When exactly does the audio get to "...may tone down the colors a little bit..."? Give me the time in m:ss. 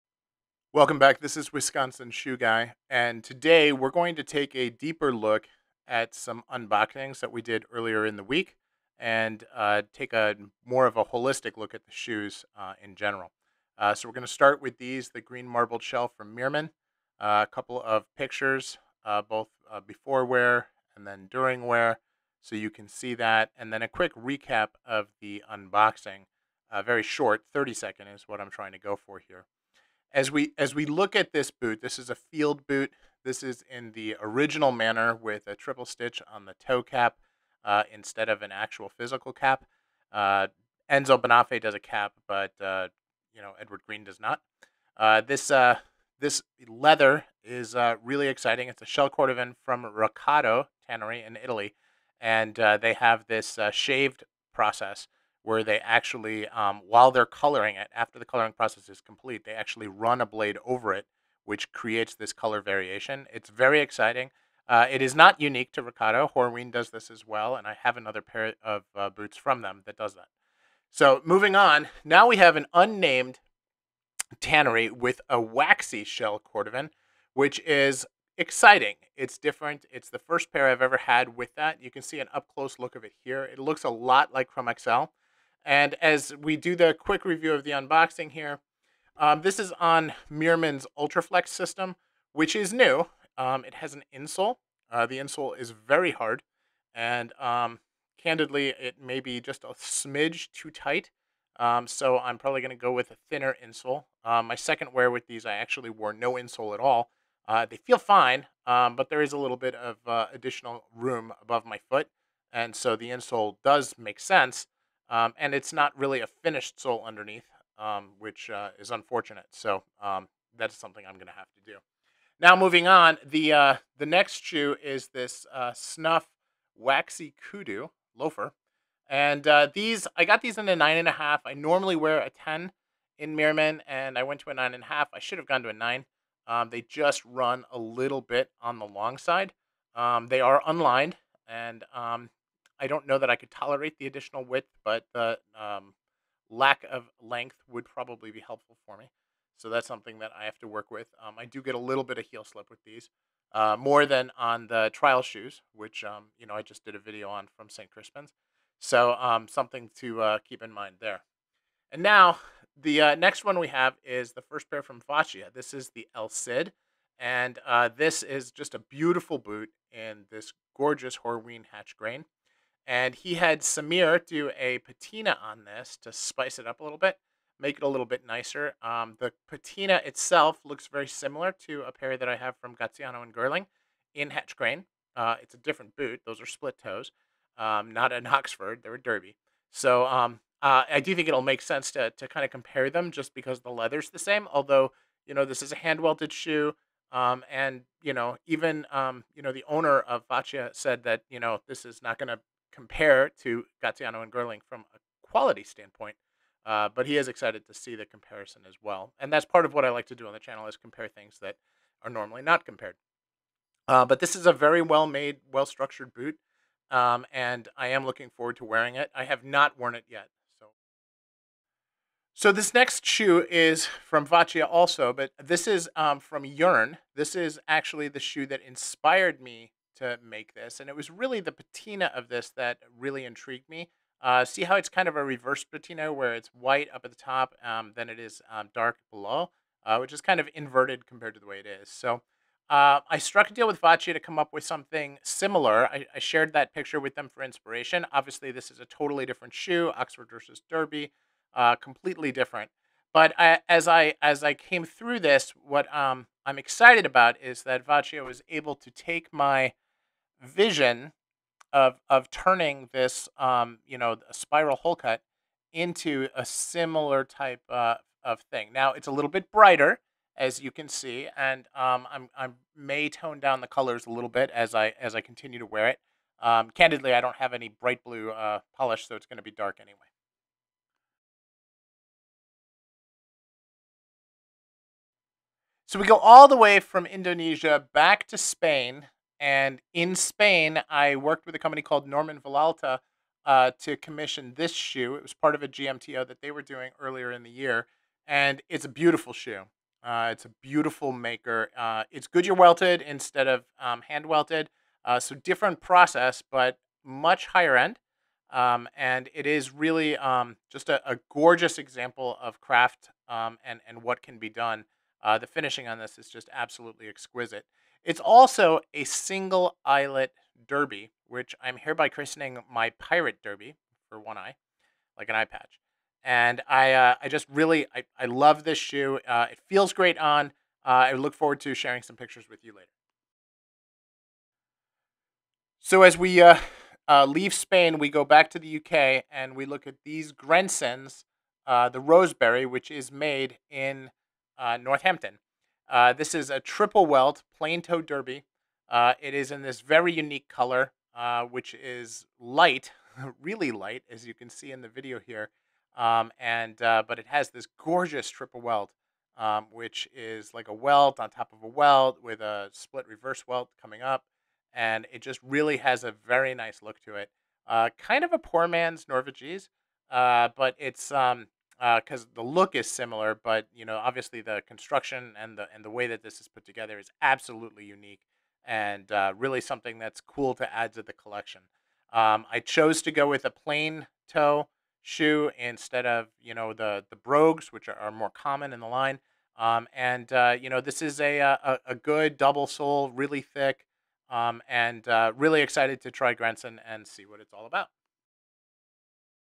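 4:32.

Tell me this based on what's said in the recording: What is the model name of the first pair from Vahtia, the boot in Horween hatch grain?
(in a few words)
El Cid.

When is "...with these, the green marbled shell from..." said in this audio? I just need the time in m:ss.
0:14.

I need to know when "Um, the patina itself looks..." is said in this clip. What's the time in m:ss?
2:58.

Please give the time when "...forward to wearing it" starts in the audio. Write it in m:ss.
3:38.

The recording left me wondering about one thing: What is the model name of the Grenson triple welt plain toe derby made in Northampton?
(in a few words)
Roseberry.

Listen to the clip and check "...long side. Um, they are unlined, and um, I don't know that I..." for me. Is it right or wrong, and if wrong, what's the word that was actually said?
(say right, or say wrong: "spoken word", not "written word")
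right.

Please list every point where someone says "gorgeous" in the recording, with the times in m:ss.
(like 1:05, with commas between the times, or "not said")
2:50, 5:11, 5:57.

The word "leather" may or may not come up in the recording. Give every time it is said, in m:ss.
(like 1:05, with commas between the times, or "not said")
0:46, 3:13.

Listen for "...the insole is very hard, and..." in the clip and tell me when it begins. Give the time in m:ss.
1:35.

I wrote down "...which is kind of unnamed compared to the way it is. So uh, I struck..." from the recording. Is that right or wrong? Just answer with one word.
wrong.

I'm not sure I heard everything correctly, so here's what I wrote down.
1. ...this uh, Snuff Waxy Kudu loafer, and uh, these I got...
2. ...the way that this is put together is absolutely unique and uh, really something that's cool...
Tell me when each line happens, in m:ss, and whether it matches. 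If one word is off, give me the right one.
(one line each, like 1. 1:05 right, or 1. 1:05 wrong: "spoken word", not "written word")
1. 2:05 right
2. 6:15 right.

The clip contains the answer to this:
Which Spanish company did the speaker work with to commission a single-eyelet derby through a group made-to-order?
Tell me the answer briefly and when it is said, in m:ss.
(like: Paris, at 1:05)
Norman Vilalta, at 4:52.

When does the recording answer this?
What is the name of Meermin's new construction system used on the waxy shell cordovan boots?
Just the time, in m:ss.
1:30.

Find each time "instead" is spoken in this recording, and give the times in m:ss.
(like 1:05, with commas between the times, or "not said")
0:37, 5:03, 6:25.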